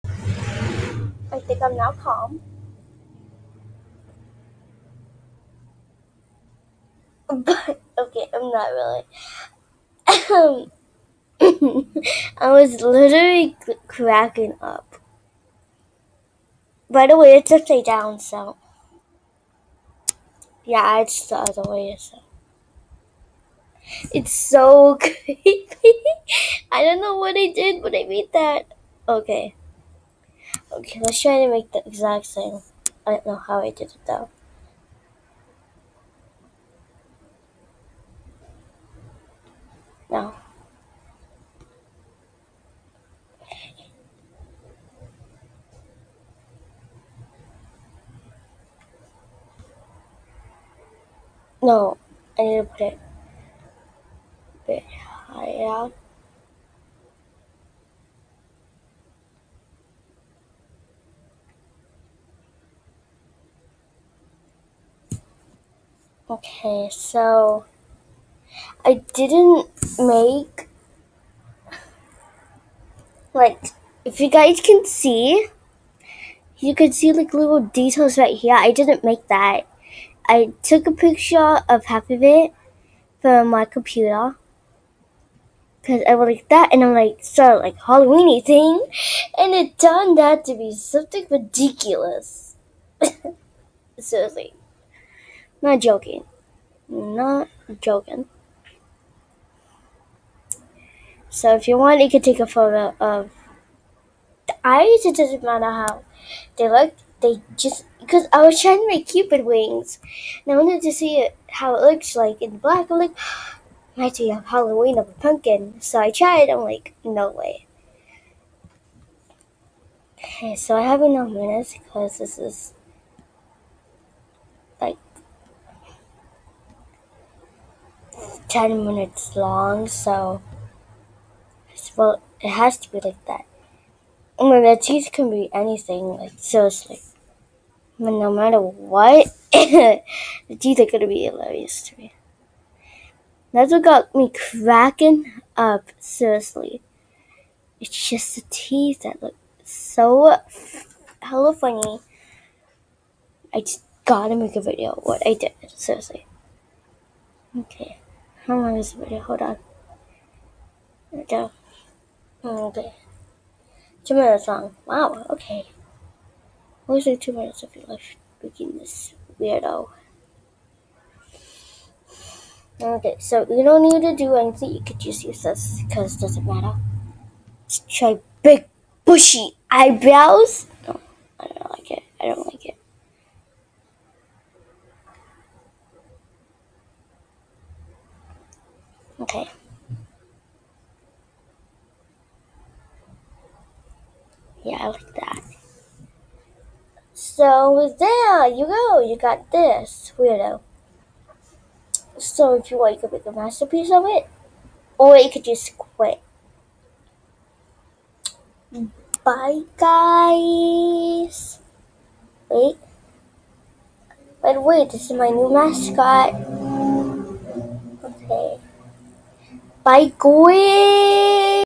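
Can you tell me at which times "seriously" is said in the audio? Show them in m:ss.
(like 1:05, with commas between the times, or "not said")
1:33, 2:16, 2:25, 2:35.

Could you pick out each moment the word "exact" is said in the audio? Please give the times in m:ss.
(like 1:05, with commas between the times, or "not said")
0:31.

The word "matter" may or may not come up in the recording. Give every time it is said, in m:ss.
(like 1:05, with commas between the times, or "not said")
1:45, 2:18, 2:56.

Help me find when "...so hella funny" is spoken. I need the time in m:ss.
2:29.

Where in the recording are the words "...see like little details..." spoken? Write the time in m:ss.
1:16.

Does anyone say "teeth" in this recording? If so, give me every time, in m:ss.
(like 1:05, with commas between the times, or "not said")
2:14, 2:20, 2:28.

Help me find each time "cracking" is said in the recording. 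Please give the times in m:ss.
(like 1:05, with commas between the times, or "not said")
0:13, 2:24.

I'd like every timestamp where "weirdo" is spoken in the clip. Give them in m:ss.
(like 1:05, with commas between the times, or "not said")
2:49, 3:20.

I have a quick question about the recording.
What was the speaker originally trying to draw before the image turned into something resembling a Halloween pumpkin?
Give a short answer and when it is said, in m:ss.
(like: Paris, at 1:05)
cupid wings, at 1:49.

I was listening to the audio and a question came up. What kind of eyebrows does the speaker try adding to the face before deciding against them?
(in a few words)
big bushy eyebrows.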